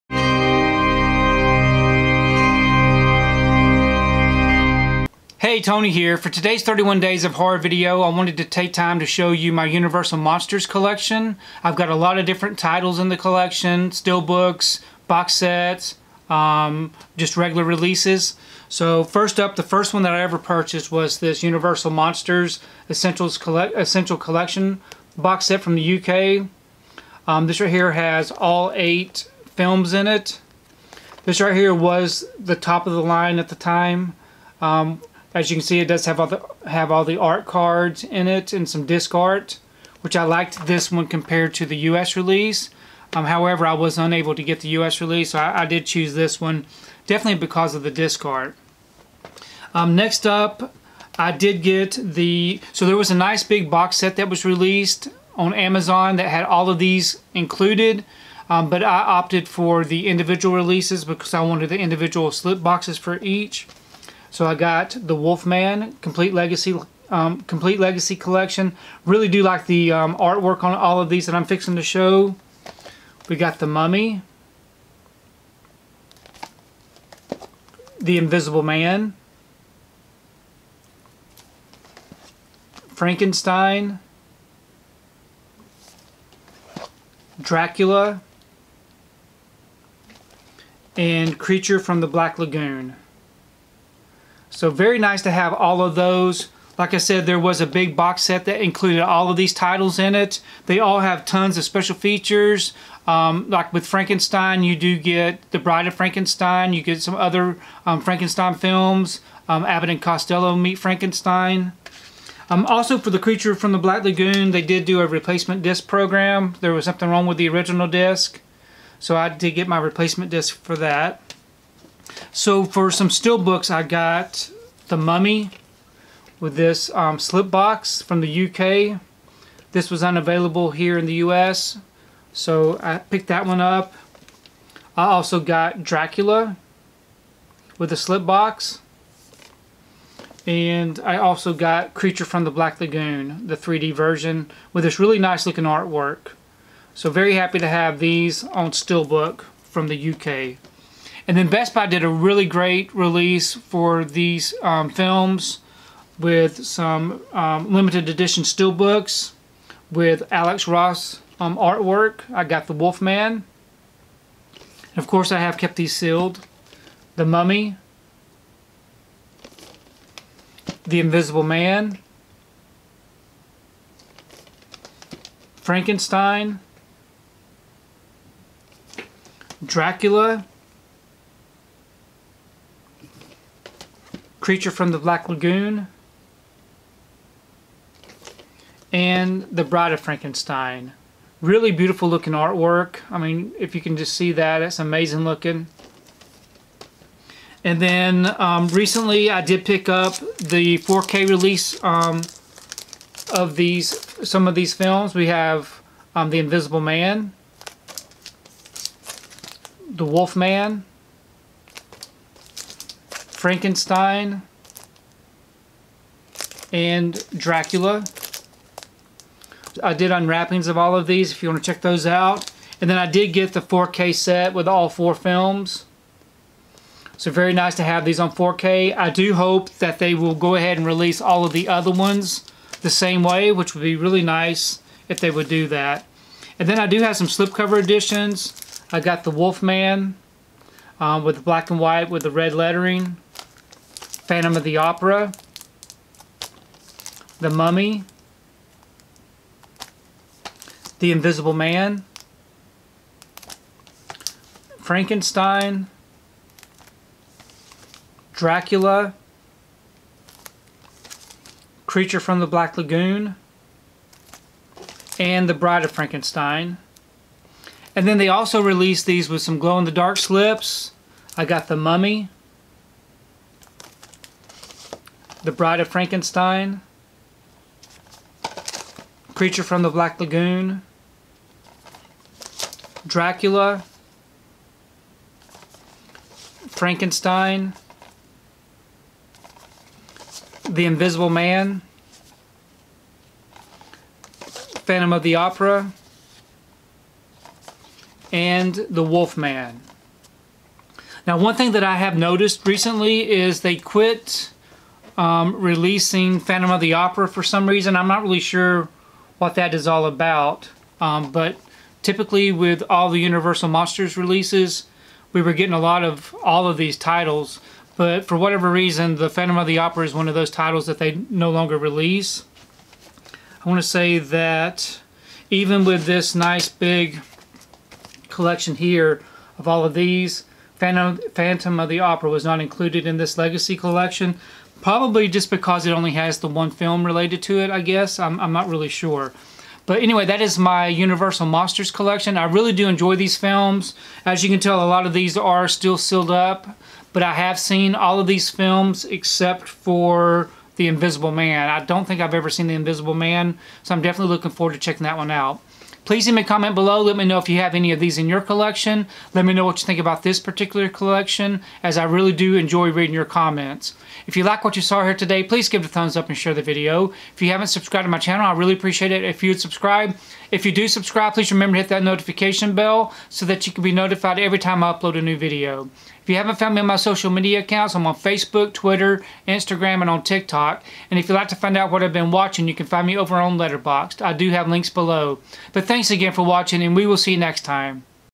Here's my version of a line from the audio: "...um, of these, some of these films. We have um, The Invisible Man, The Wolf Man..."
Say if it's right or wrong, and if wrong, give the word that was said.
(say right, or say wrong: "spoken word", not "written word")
right.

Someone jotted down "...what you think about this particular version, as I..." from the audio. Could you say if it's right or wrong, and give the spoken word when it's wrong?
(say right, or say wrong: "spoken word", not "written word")
wrong: "collection", not "version".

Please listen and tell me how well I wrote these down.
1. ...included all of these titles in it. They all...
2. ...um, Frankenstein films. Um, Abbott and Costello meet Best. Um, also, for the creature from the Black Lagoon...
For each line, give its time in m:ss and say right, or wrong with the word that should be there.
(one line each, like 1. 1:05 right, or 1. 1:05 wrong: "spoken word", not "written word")
1. 1:38 right
2. 1:47 wrong: "Frankenstein", not "Best".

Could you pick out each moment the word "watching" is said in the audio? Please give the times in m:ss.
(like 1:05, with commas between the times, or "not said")
6:22, 6:26.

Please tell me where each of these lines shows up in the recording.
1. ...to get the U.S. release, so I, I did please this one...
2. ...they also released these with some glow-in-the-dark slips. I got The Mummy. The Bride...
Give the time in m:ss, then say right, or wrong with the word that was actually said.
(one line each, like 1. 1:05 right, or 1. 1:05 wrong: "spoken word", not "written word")
1. 0:44 wrong: "choose", not "please"
2. 4:28 right.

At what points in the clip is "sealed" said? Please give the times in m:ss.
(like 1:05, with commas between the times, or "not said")
2:45, 5:45.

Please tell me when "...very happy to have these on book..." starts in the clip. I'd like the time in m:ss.
2:27.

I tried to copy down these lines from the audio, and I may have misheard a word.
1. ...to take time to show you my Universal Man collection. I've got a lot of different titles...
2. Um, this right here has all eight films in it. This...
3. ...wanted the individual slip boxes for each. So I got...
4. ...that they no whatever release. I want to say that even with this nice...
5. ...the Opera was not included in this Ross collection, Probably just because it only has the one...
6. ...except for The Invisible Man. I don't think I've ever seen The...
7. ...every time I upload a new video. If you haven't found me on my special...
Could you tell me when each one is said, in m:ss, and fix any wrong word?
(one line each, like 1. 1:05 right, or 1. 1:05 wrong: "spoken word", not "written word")
1. 0:08 wrong: "Monsters", not "Man"
2. 0:27 right
3. 1:01 right
4. 5:20 wrong: "longer", not "whatever"
5. 5:31 wrong: "Legacy", not "Ross"
6. 5:49 right
7. 6:14 wrong: "social", not "special".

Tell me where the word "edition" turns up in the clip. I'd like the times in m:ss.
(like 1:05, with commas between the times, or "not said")
2:38, 3:57.